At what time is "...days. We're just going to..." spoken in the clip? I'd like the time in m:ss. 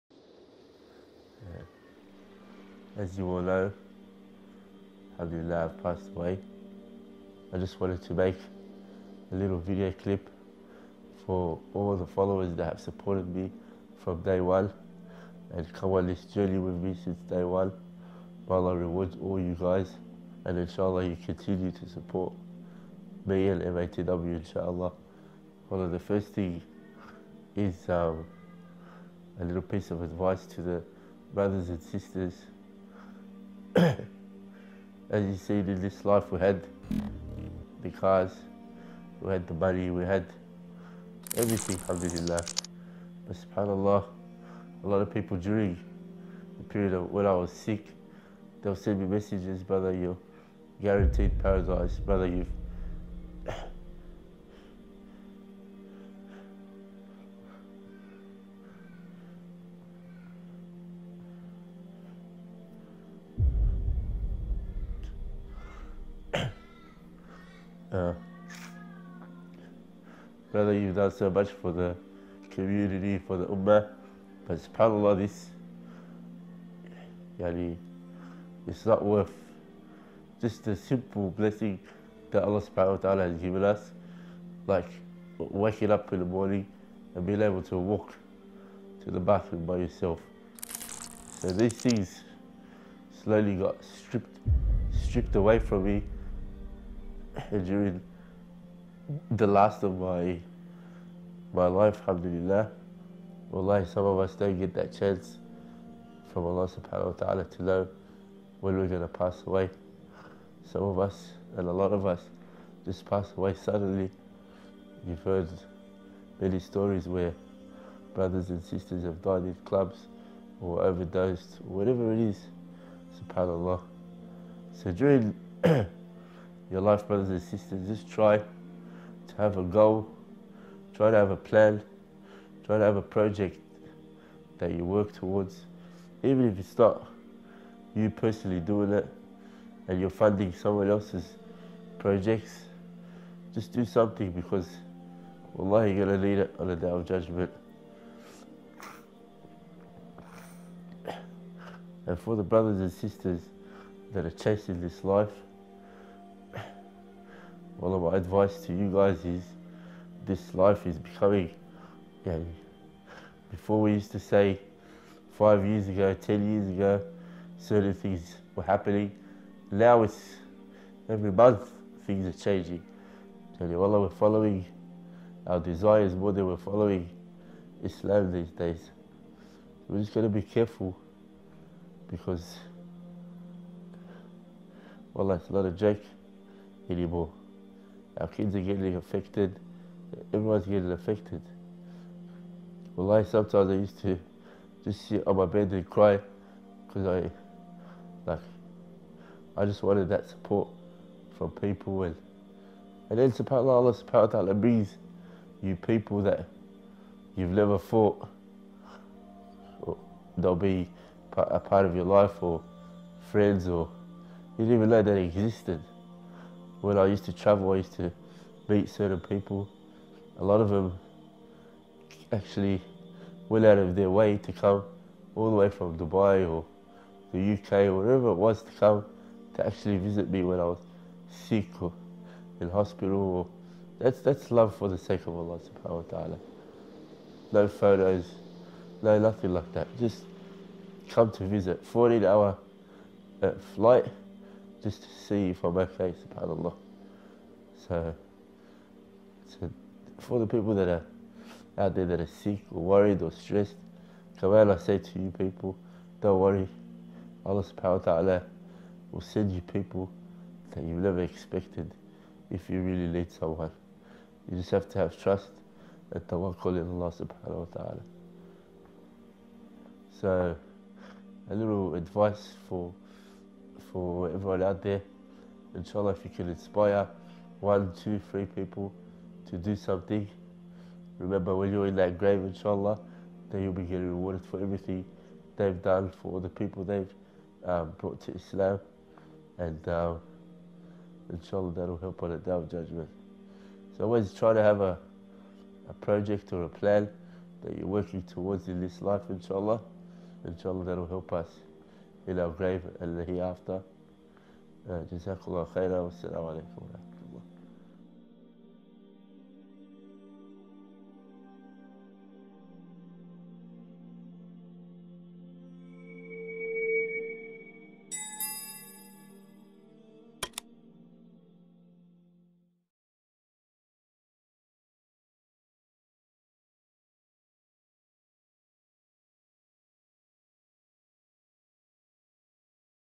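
2:58.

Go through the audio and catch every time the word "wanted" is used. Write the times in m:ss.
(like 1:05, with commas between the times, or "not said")
0:07, 3:19.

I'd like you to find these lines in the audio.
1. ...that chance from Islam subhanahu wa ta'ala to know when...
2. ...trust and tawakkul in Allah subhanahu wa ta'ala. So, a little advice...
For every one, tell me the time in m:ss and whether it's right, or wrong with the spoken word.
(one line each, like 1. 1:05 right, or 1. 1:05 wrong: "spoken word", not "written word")
1. 1:44 wrong: "Allah", not "Islam"
2. 4:25 right.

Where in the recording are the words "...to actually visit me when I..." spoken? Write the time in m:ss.
3:49.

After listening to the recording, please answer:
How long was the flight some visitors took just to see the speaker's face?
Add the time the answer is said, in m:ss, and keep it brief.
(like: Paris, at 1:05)
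14 hours, at 4:01.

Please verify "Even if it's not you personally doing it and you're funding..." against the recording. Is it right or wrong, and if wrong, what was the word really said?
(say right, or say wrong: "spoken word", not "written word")
right.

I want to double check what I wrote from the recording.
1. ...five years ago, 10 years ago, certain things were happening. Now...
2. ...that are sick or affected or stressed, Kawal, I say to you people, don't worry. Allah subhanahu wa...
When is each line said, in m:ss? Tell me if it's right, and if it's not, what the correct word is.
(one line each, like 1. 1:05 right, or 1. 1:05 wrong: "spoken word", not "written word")
1. 2:45 right
2. 4:12 wrong: "worried", not "affected".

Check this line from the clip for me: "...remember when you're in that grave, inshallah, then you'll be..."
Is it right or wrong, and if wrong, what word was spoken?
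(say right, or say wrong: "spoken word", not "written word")
right.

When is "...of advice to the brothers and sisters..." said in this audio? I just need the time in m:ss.
0:29.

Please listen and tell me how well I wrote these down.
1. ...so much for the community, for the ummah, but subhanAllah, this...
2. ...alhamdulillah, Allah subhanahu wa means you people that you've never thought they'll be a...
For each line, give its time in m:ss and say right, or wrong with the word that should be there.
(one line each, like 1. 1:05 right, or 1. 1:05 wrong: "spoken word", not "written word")
1. 1:11 right
2. 3:23 wrong: "subhanAllah", not "alhamdulillah".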